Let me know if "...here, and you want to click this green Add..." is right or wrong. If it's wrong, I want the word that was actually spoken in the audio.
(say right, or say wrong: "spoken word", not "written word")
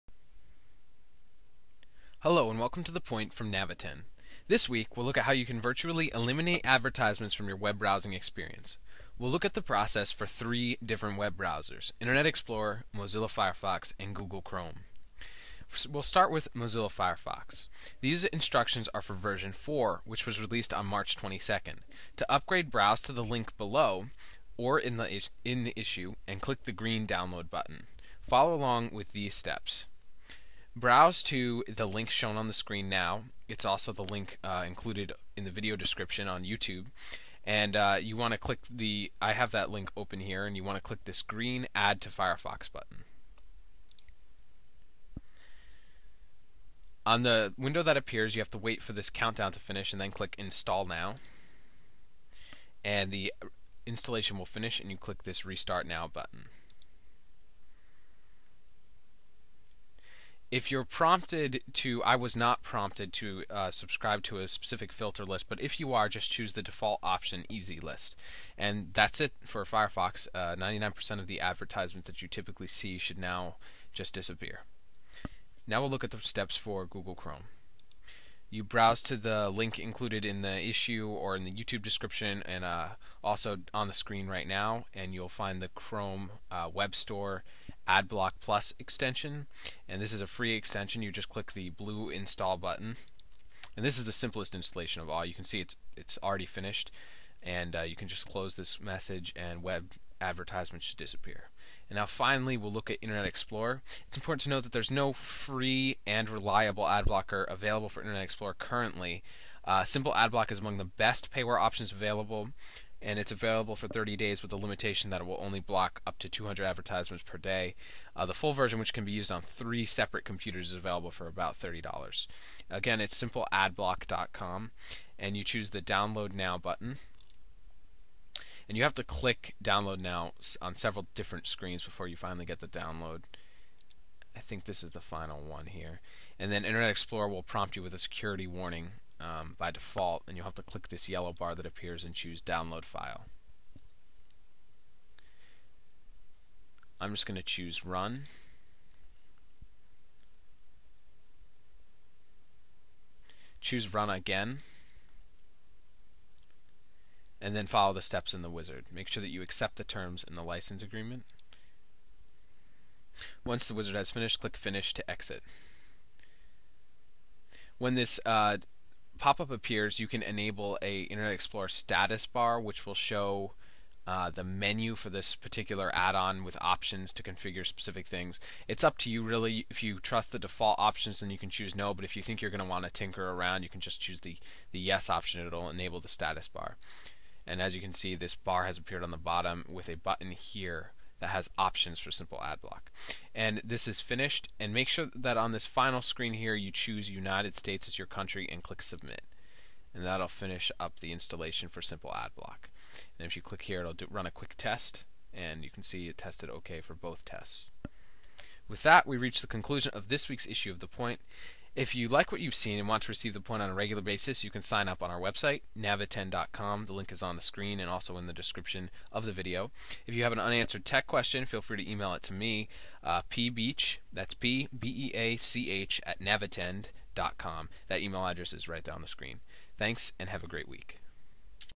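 right.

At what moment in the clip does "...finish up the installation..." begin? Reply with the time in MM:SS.
03:20.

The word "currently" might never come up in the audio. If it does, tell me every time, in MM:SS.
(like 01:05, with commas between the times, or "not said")
01:48.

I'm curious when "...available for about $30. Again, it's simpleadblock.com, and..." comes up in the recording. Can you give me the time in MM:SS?
02:00.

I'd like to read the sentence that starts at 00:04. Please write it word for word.
This week, we'll look at how you can virtually eliminate advertisements from your web browsing experience.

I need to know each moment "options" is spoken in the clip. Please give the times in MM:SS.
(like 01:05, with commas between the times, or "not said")
01:07, 01:51, 02:56, 03:00, 03:05, 03:11.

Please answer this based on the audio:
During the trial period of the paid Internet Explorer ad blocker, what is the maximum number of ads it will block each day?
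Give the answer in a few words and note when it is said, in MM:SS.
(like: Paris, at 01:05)
200, at 01:56.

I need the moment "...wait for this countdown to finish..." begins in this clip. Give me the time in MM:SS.
00:48.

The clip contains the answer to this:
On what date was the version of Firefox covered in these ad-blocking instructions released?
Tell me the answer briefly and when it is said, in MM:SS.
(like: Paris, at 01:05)
March 22nd, at 00:20.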